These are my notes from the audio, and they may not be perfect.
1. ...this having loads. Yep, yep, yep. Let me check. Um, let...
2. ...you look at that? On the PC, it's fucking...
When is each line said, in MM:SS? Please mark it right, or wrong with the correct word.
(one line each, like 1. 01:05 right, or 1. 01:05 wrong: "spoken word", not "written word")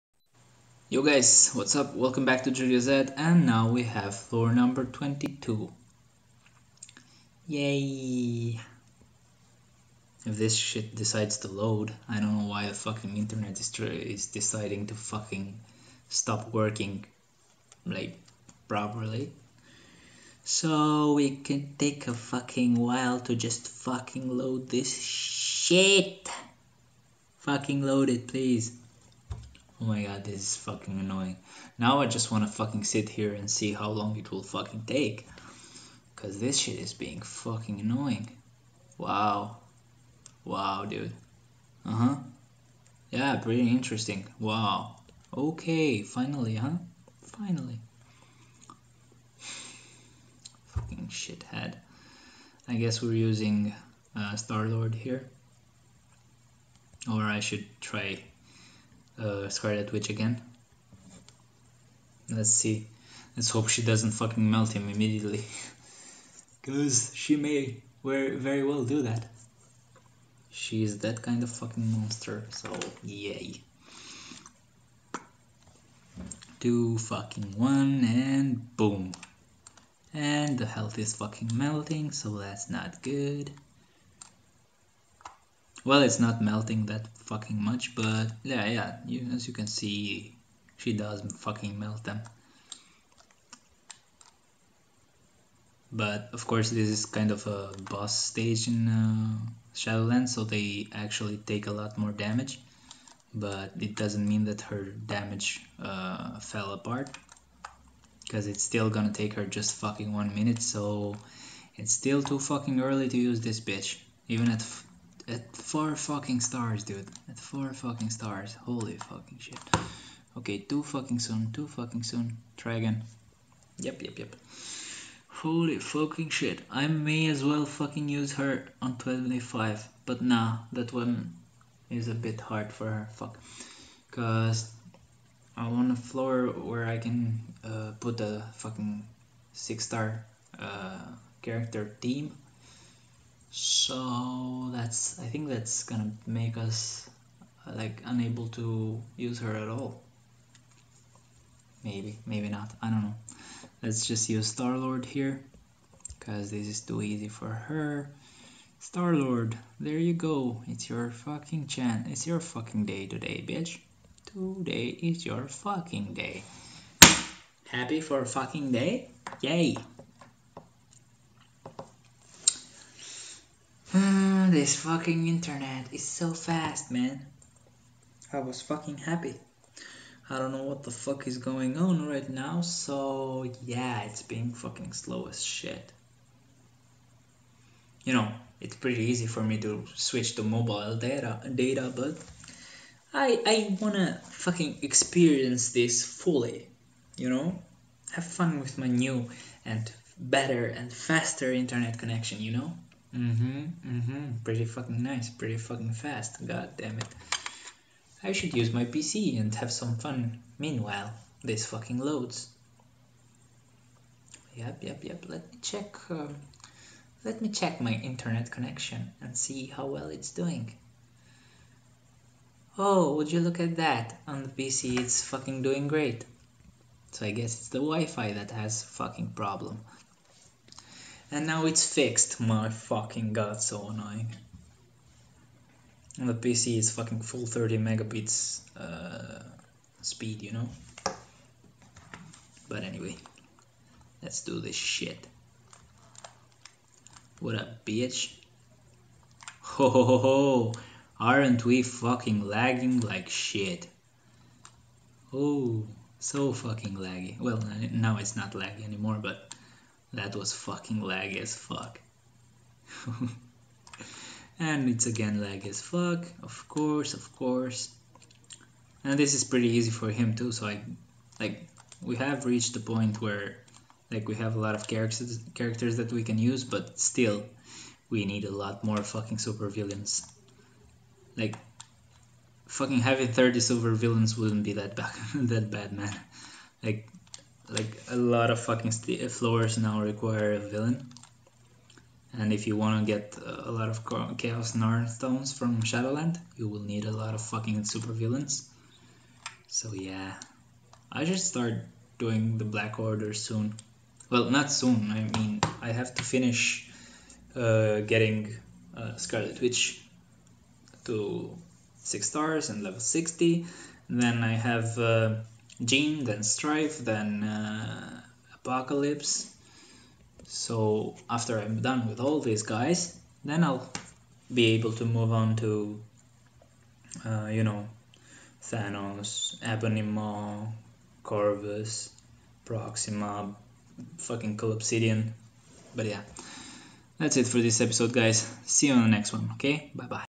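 1. 03:31 wrong: "fucking", not "having"
2. 03:43 right.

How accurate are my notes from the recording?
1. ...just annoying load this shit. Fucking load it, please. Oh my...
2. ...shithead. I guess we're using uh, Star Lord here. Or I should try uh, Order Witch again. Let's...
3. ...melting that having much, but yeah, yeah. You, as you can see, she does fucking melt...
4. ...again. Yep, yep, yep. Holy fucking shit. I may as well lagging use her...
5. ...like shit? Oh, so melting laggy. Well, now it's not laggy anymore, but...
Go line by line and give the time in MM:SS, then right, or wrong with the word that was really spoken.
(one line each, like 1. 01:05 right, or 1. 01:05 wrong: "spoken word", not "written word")
1. 00:23 wrong: "fucking", not "annoying"
2. 00:51 wrong: "Scarlet", not "Order"
3. 01:26 wrong: "fucking", not "having"
4. 02:02 wrong: "fucking", not "lagging"
5. 04:12 wrong: "fucking", not "melting".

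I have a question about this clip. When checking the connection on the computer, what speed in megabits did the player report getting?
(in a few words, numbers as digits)
30.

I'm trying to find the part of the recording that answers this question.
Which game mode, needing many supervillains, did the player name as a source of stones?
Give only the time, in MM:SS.
04:55.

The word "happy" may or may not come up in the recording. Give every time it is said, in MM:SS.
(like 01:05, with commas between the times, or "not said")
02:47, 02:58.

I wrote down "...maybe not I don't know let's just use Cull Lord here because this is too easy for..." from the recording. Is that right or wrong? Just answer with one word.
wrong.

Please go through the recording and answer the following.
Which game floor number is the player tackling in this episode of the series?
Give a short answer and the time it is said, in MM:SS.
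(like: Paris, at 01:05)
22, at 00:04.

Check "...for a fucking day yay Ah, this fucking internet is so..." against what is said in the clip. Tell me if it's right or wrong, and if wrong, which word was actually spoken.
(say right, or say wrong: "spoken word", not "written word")
right.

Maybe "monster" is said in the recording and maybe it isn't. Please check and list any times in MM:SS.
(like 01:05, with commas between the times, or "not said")
01:11.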